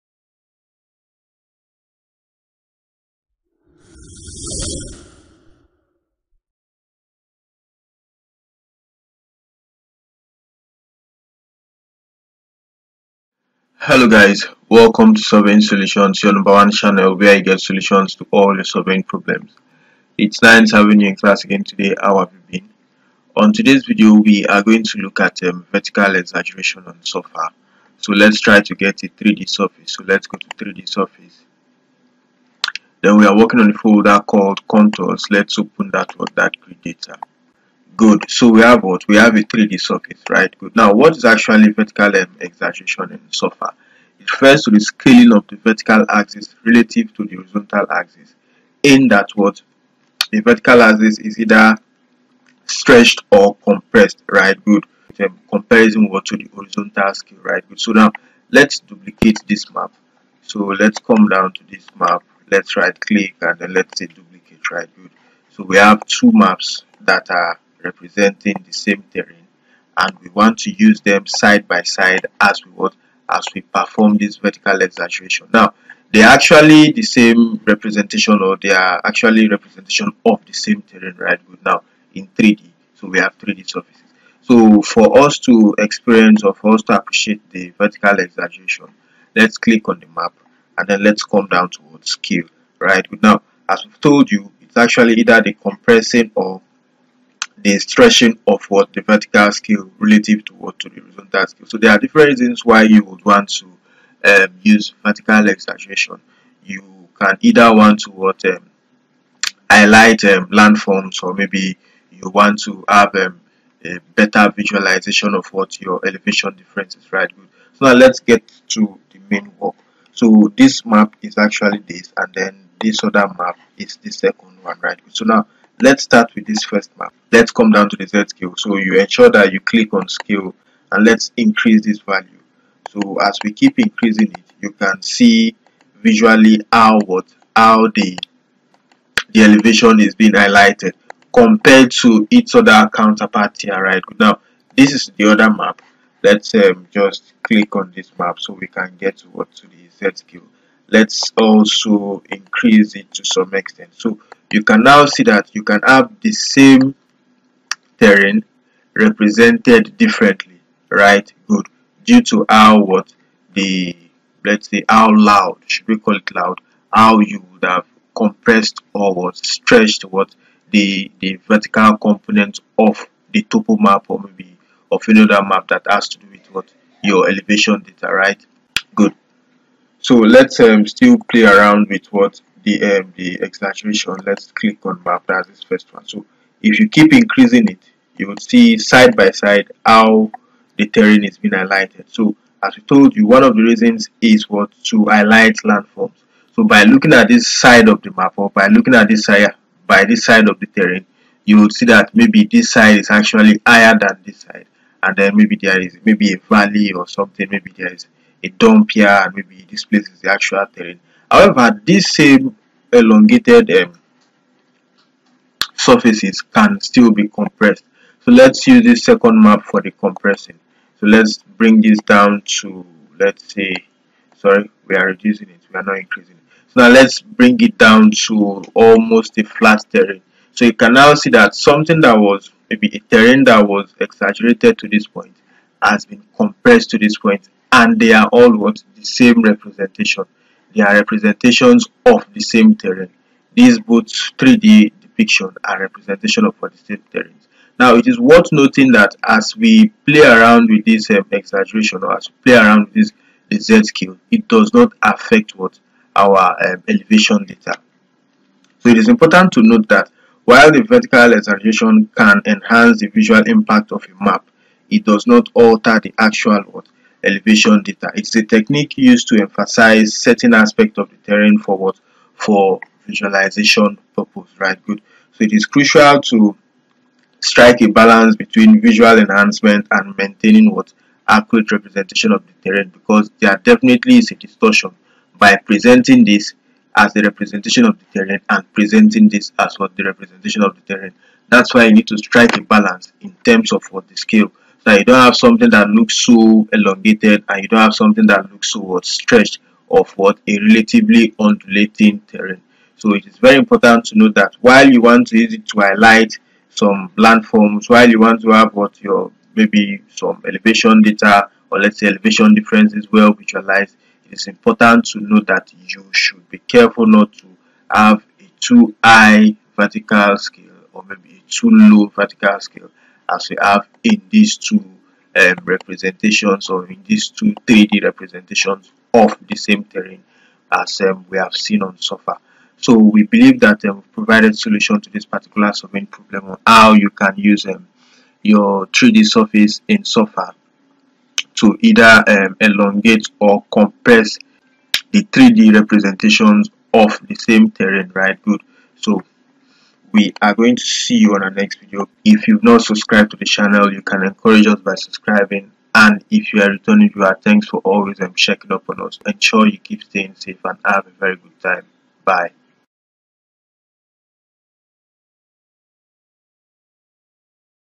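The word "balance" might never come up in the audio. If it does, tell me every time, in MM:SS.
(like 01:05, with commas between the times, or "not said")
04:37, 04:52.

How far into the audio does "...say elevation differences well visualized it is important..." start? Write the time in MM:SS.
05:11.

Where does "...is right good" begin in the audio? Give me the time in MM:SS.
01:56.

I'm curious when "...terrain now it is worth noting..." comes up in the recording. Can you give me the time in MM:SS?
04:07.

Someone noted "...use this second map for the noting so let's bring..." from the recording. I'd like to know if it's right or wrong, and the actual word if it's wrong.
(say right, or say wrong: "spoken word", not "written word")
wrong: "compressing", not "noting".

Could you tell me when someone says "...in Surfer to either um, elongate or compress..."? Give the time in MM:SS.
05:39.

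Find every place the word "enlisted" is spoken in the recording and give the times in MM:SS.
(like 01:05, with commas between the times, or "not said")
not said.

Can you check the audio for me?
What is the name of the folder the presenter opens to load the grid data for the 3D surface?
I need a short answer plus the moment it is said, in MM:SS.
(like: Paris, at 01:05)
contours, at 00:34.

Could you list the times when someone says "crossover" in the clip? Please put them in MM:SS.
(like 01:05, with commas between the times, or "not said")
not said.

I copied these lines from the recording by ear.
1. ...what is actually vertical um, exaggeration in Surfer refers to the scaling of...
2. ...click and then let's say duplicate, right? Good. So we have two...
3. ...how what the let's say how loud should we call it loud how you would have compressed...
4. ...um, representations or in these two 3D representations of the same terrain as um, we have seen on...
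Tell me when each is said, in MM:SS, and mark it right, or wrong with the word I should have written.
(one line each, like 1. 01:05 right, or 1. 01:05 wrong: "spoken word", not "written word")
1. 00:40 right
2. 01:02 right
3. 02:42 right
4. 05:25 right.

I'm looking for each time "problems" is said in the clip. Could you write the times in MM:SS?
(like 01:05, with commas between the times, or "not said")
00:19, 05:36.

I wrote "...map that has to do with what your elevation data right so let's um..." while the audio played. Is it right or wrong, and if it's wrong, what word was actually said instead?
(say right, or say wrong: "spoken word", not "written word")
right.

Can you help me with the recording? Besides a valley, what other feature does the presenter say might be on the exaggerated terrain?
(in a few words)
a dump.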